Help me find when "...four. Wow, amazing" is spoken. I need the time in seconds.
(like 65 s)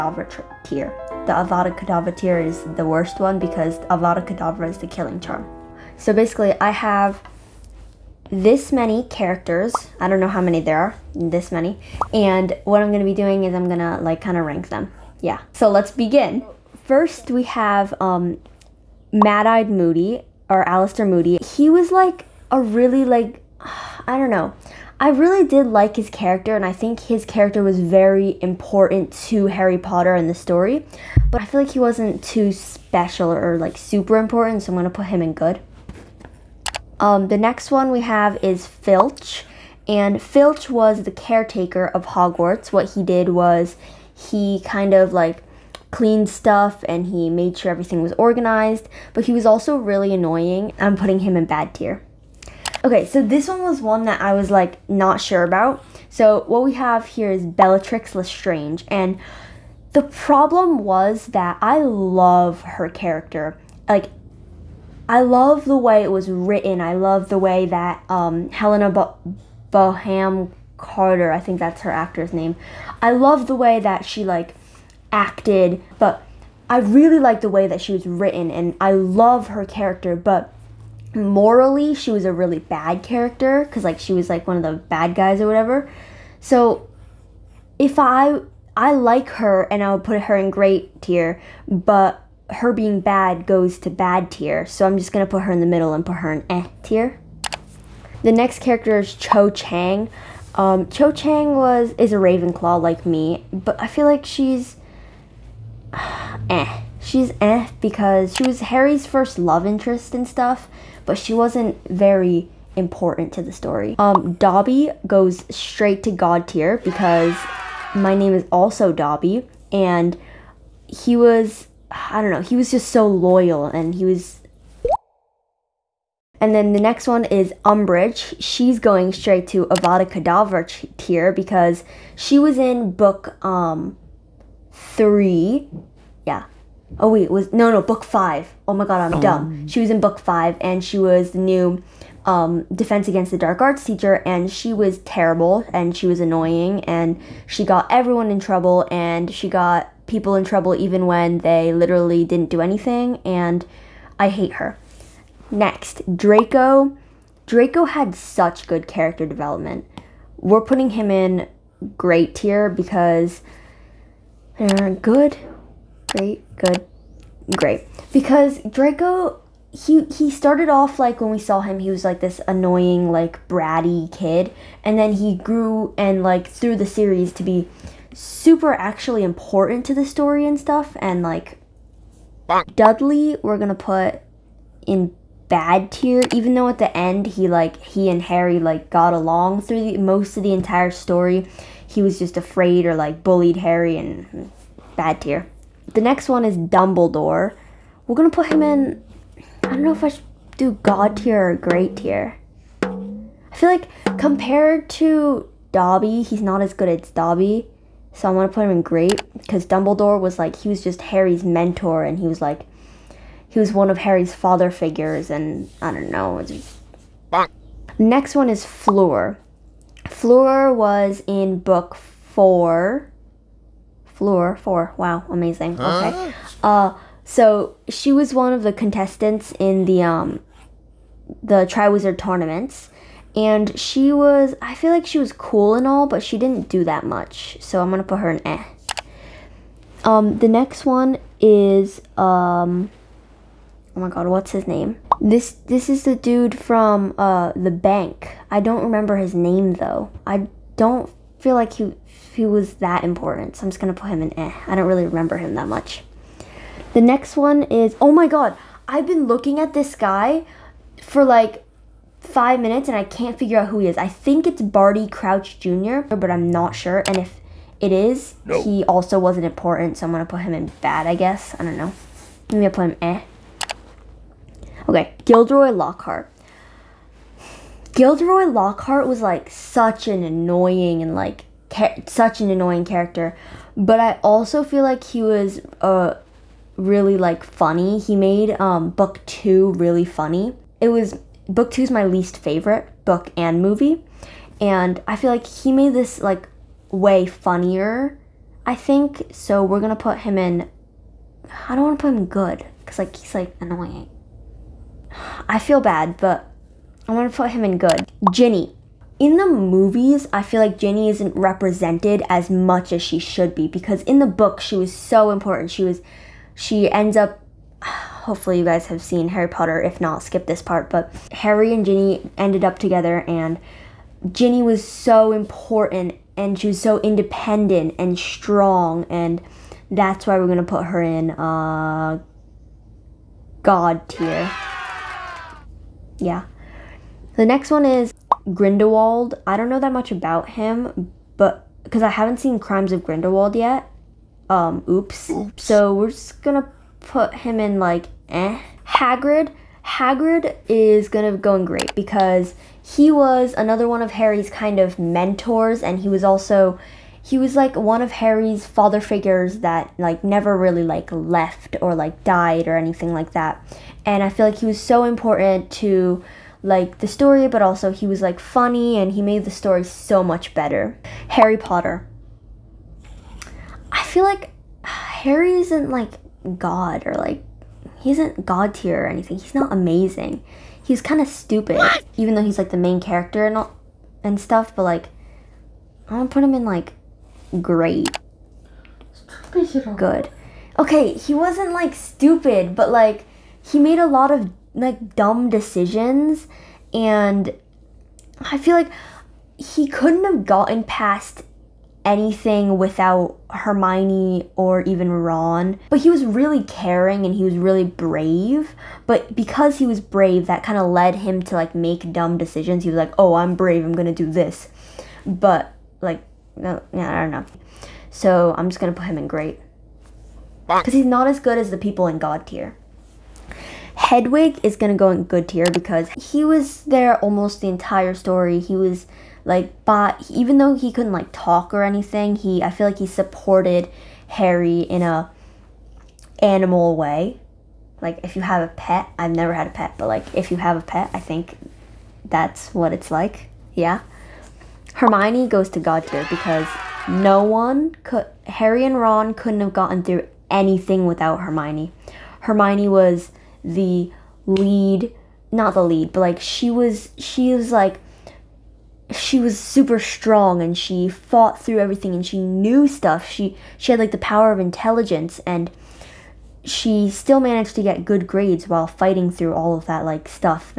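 224 s.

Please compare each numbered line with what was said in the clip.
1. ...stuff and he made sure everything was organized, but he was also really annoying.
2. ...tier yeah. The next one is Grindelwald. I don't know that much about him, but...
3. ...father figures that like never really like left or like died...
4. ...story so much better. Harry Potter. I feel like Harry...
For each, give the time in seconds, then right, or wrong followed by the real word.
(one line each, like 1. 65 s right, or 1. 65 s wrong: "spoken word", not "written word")
1. 46 s right
2. 334 s right
3. 358 s right
4. 369 s right.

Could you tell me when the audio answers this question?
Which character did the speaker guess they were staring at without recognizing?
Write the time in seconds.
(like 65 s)
264 s.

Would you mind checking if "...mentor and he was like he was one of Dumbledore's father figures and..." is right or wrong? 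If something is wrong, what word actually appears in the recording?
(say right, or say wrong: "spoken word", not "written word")
wrong: "Harry", not "Dumbledore".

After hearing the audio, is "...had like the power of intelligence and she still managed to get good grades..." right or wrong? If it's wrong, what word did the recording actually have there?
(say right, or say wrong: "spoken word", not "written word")
right.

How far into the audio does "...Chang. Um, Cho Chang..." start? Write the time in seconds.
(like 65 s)
99 s.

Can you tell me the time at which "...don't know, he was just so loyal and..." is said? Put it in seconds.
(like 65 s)
122 s.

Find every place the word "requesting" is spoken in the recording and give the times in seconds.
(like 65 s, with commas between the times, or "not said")
not said.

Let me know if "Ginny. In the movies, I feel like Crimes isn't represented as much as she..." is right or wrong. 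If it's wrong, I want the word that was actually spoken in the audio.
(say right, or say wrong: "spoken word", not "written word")
wrong: "Ginny", not "Crimes".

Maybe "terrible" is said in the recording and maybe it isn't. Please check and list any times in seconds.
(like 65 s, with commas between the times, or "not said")
144 s.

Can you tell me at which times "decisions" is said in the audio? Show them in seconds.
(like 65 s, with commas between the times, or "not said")
395 s, 412 s.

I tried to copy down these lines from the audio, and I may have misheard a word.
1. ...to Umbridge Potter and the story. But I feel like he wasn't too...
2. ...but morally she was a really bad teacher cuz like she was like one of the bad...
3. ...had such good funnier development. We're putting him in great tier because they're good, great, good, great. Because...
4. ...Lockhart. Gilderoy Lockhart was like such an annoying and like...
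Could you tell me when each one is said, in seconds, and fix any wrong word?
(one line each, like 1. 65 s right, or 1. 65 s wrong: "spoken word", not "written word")
1. 29 s wrong: "Harry", not "Umbridge"
2. 80 s wrong: "character", not "teacher"
3. 157 s wrong: "character", not "funnier"
4. 275 s right.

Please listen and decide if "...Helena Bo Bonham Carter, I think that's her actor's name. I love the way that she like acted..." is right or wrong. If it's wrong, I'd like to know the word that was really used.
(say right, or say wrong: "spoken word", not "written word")
right.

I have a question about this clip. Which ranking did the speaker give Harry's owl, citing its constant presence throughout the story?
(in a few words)
Good tier.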